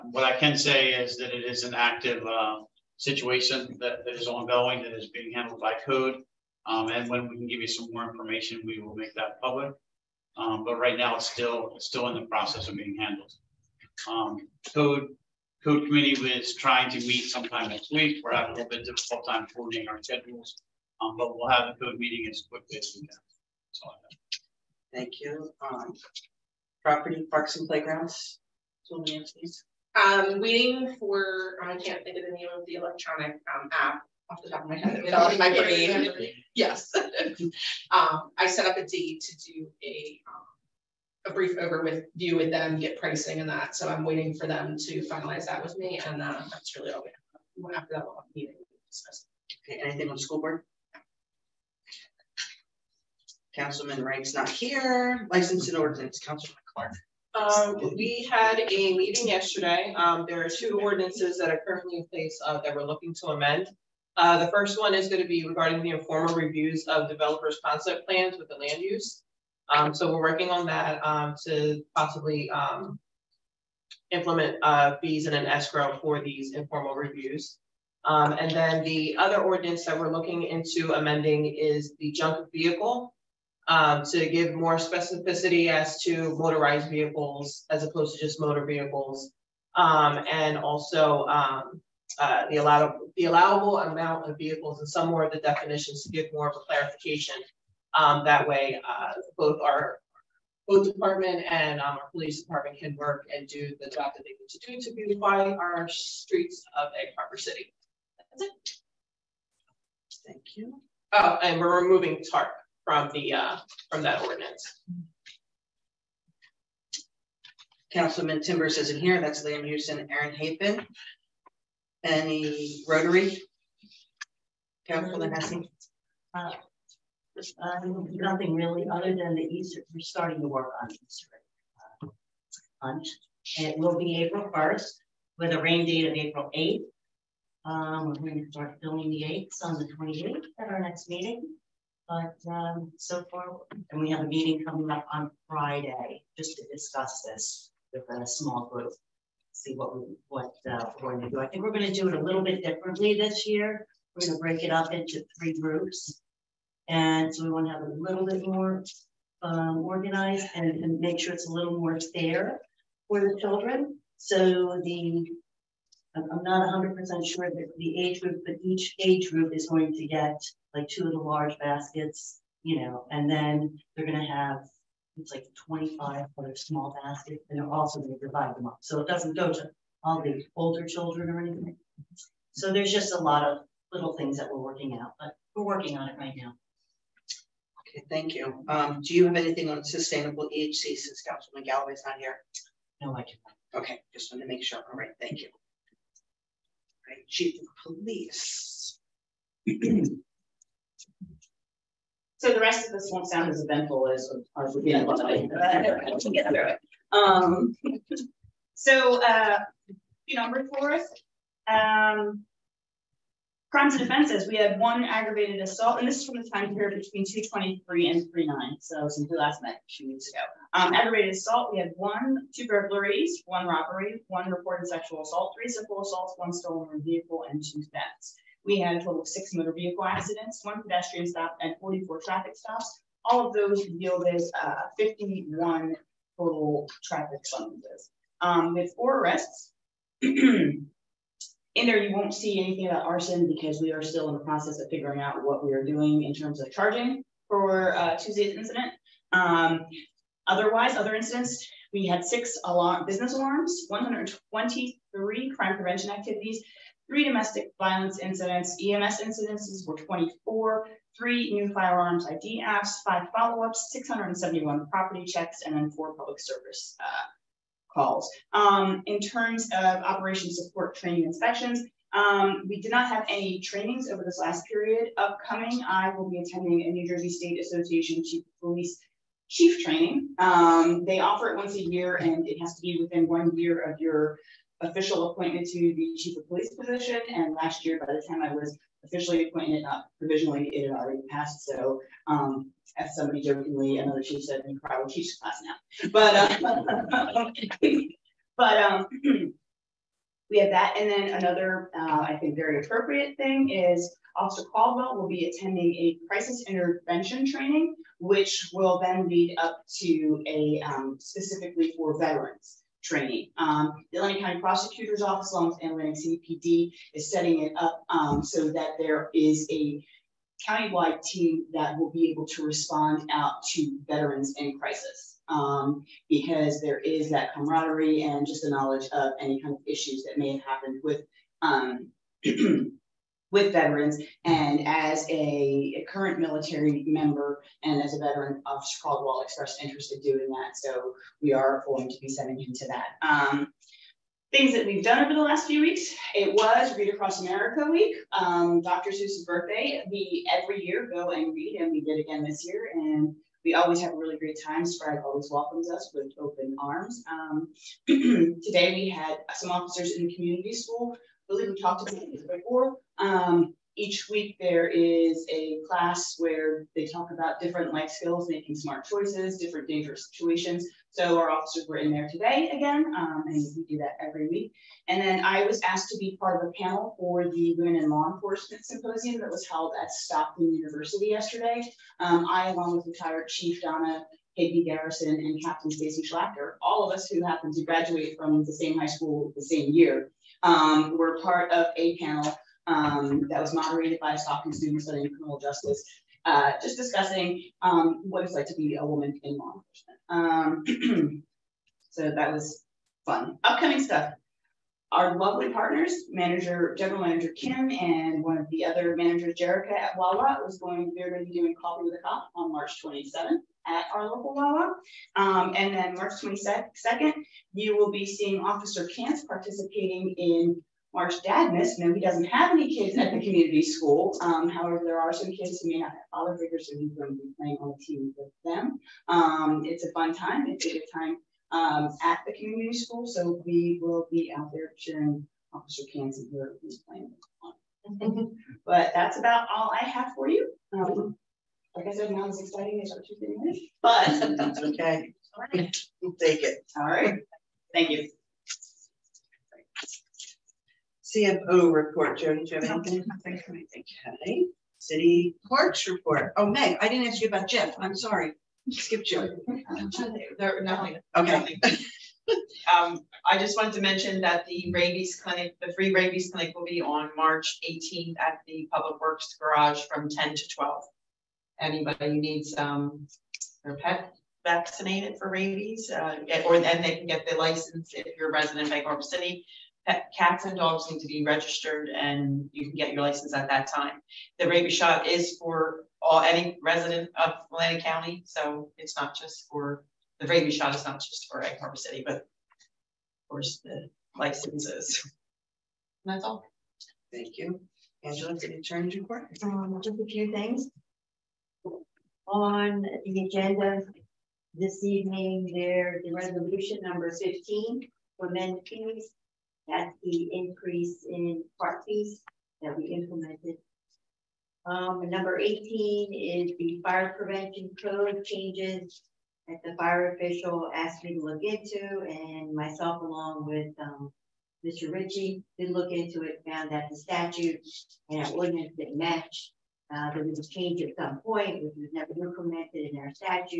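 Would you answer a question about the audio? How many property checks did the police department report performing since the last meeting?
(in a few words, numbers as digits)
671.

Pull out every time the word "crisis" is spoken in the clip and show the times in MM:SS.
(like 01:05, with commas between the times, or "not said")
05:06, 05:24.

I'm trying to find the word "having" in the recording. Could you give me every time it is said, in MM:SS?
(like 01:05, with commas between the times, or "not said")
00:18.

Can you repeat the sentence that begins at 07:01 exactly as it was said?
Now, he doesn't have any kids at the community school.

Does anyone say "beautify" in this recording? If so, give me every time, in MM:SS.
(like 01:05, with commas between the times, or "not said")
01:44.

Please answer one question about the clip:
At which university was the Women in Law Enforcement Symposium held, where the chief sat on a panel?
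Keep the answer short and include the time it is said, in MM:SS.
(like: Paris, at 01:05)
Stockton University, at 06:20.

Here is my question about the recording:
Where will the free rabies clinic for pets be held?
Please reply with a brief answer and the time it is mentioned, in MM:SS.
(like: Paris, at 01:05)
Public Works Garage, at 07:48.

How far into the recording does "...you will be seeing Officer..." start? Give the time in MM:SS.
06:57.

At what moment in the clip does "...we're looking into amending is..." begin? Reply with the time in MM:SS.
01:19.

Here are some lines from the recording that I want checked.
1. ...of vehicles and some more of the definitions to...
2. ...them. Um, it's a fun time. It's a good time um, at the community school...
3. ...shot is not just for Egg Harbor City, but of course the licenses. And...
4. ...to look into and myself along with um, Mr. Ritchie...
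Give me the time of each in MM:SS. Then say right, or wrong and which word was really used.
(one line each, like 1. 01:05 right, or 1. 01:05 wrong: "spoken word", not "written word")
1. 01:34 right
2. 07:08 right
3. 08:10 right
4. 08:41 right.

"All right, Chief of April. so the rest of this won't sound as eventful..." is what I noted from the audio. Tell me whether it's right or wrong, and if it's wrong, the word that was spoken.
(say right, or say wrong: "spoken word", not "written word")
wrong: "Police", not "April".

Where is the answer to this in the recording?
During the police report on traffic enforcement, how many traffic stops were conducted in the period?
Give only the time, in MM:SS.
03:51.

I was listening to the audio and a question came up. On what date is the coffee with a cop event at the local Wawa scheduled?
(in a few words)
March 27th.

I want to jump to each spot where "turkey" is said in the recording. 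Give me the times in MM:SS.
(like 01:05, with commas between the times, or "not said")
not said.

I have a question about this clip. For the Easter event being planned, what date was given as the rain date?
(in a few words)
April 8th.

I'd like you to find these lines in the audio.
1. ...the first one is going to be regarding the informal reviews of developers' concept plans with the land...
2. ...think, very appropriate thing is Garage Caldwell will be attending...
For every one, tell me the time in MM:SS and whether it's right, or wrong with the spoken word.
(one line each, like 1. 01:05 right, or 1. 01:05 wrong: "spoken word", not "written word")
1. 01:04 right
2. 05:02 wrong: "Officer", not "Garage".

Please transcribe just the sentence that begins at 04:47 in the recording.
And last year, by the time I was officially appointed, not provisionally, it had already passed.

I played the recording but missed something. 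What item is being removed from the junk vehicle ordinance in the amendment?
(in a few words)
TARP.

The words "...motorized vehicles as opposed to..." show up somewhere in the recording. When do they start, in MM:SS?
01:26.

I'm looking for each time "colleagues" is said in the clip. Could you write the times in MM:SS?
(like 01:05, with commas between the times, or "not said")
not said.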